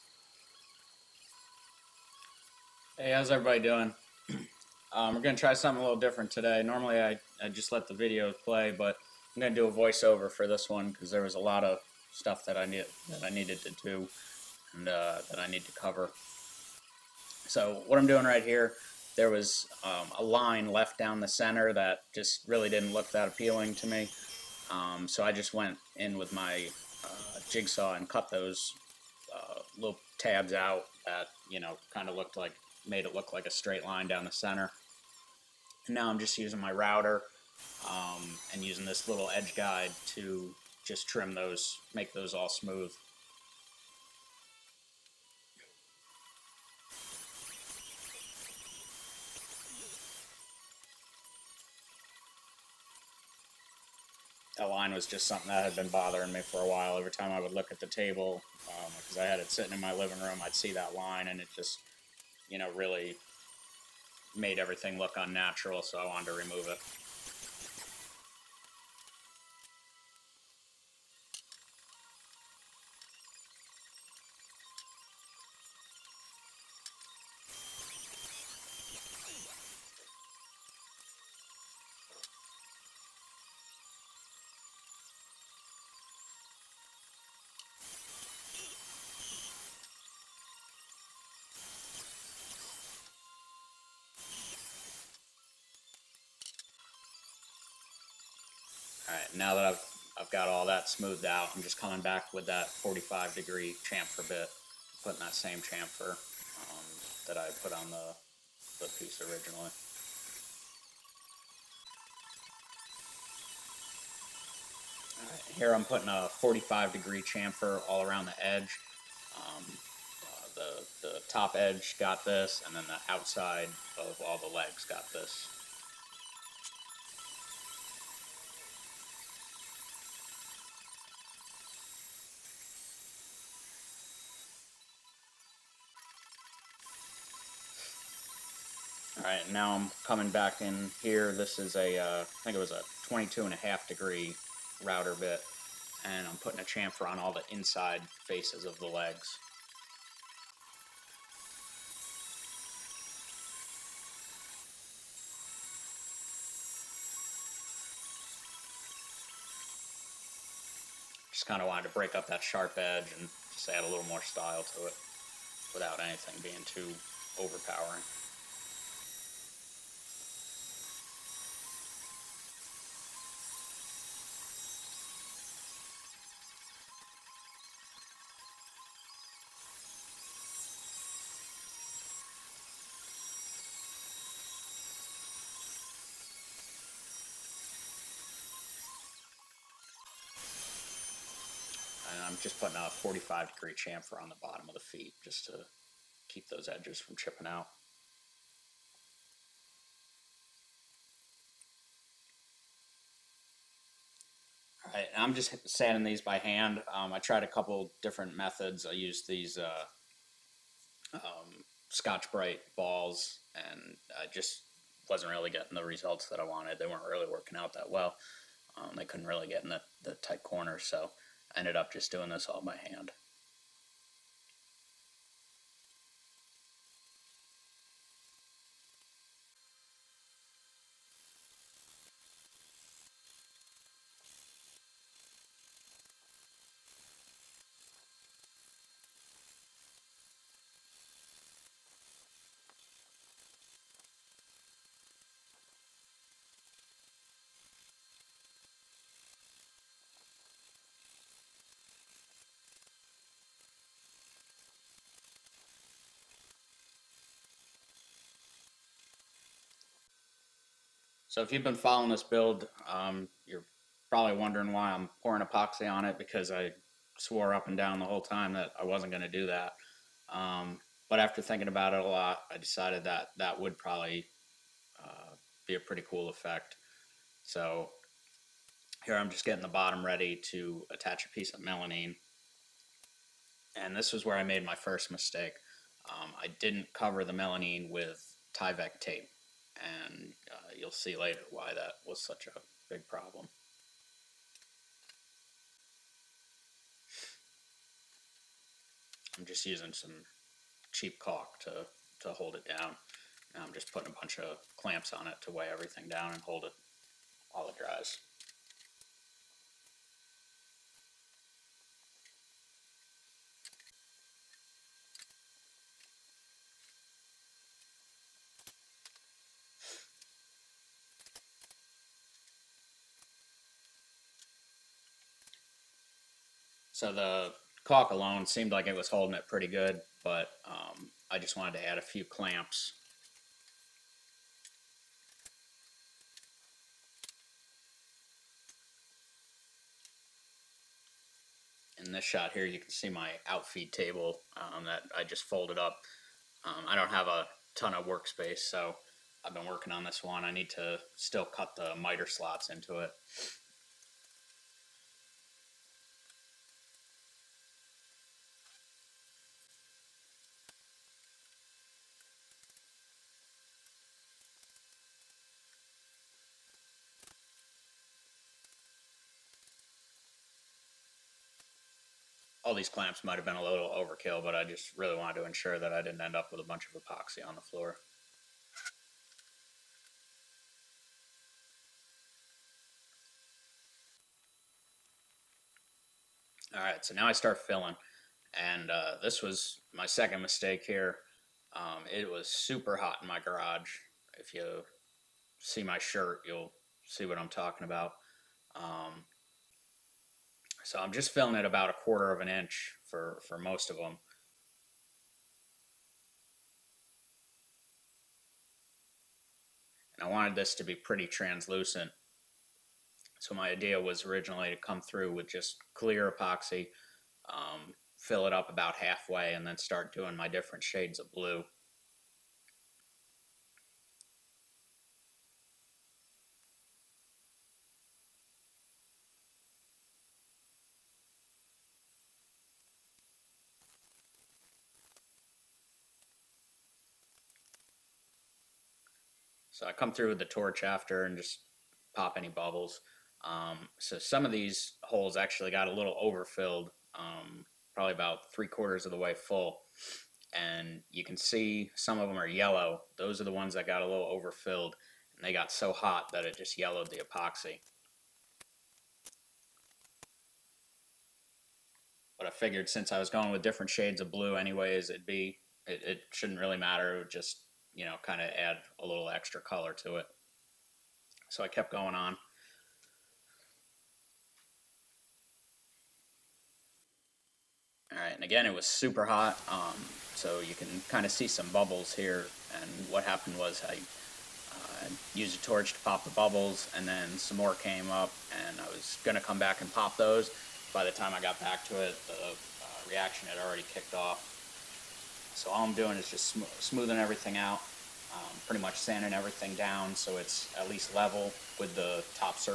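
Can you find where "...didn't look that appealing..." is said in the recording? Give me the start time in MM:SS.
00:22.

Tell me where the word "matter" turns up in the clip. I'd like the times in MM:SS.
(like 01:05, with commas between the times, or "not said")
07:46.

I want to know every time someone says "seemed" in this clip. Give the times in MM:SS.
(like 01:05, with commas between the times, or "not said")
05:28.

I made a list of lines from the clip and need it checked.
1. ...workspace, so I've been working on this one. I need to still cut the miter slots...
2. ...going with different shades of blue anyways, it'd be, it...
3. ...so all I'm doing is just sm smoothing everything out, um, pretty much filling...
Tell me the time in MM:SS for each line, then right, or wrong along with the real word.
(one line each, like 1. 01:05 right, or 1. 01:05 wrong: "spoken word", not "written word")
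1. 05:48 right
2. 07:43 right
3. 08:15 wrong: "sanding", not "filling".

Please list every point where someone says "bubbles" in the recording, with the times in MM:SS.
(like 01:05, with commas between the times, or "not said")
07:22, 08:01, 08:06.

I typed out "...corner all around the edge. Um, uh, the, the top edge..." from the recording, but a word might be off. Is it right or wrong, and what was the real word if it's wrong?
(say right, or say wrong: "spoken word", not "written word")
wrong: "chamfer", not "corner".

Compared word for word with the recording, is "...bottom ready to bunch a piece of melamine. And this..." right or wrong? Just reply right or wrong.
wrong.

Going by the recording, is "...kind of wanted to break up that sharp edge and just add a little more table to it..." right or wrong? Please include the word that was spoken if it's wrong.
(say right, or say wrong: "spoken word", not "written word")
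wrong: "style", not "table".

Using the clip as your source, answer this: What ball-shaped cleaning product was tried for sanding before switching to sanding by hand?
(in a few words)
Scotch Brite balls.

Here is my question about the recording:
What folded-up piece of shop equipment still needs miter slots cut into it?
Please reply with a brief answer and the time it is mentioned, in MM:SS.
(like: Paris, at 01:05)
outfeed table, at 05:43.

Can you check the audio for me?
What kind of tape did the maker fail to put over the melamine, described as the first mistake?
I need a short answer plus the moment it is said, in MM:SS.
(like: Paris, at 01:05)
Tyvek tape, at 04:48.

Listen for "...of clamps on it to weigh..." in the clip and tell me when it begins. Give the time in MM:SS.
05:04.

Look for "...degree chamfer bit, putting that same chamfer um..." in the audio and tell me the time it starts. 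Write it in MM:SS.
01:43.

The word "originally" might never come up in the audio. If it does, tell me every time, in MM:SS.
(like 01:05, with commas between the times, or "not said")
01:49, 06:54.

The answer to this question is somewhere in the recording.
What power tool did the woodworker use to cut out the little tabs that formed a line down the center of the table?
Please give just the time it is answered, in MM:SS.
00:27.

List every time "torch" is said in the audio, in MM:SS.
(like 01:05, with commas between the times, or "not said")
07:20, 08:05.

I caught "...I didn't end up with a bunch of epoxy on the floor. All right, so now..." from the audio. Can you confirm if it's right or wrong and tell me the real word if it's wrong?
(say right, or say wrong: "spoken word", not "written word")
right.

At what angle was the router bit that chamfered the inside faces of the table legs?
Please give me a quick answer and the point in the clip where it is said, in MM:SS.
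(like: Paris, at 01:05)
22.5 degrees, at 02:23.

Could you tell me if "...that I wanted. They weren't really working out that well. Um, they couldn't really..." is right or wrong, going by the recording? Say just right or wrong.
right.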